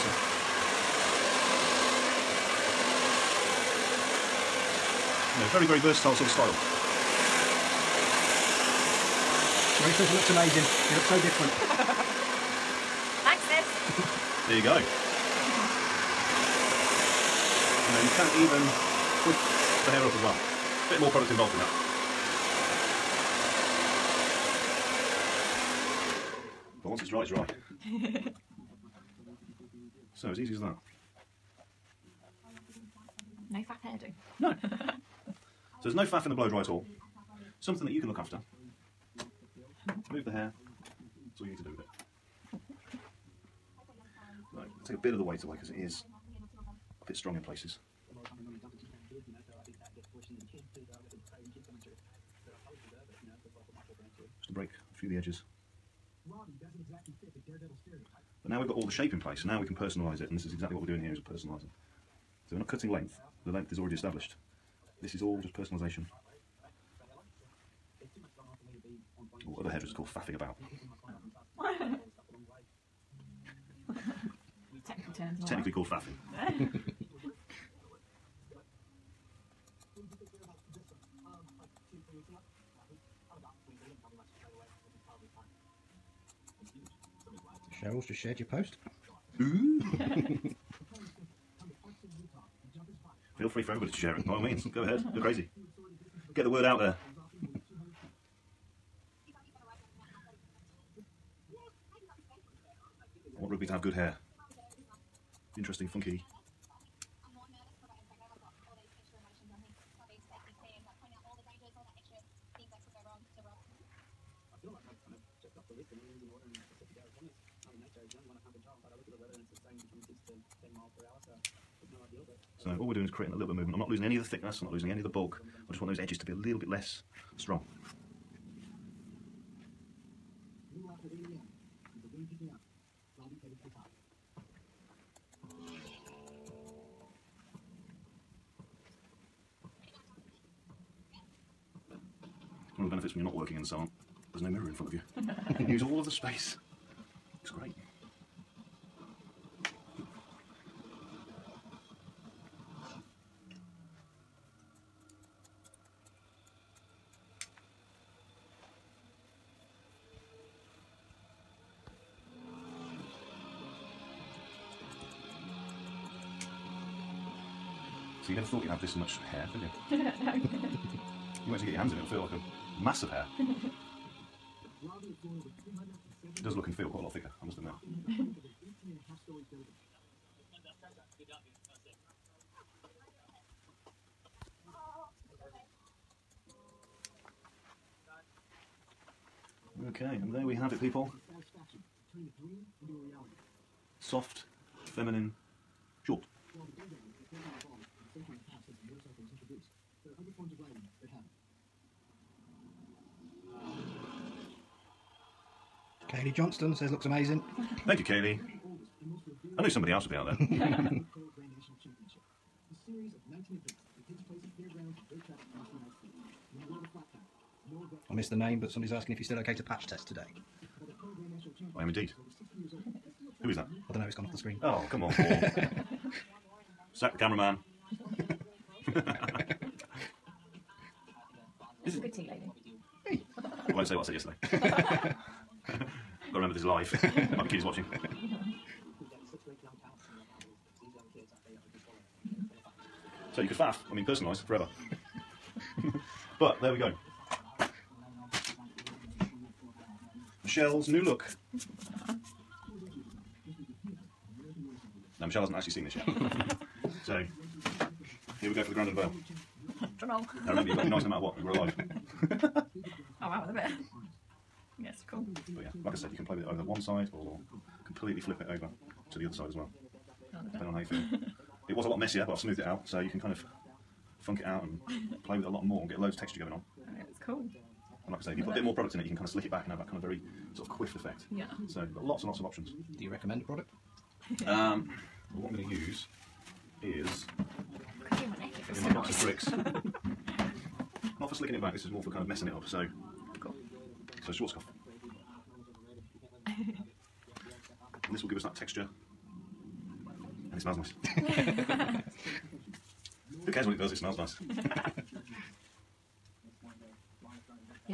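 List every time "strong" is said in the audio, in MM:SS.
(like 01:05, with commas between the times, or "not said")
00:47, 02:07.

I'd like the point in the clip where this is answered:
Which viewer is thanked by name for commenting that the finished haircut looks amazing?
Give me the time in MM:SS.
03:26.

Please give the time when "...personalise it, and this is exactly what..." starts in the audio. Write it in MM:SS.
00:59.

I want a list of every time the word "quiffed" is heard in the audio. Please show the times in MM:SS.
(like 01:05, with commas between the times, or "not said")
04:40.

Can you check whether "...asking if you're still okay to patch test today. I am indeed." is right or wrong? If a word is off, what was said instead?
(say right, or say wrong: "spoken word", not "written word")
right.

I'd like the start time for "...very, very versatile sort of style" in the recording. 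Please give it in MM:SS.
00:05.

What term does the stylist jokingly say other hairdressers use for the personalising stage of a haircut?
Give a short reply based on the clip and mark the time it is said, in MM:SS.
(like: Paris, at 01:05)
Faffing about, at 01:10.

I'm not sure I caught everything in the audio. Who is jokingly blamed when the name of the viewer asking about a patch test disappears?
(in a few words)
Paul.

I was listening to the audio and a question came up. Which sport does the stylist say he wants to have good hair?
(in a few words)
Rugby.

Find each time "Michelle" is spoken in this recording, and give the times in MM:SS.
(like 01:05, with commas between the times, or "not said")
04:10, 04:15.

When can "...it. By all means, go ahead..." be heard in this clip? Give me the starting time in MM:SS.
01:34.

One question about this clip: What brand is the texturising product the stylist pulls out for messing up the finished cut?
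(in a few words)
Schwarzkopf.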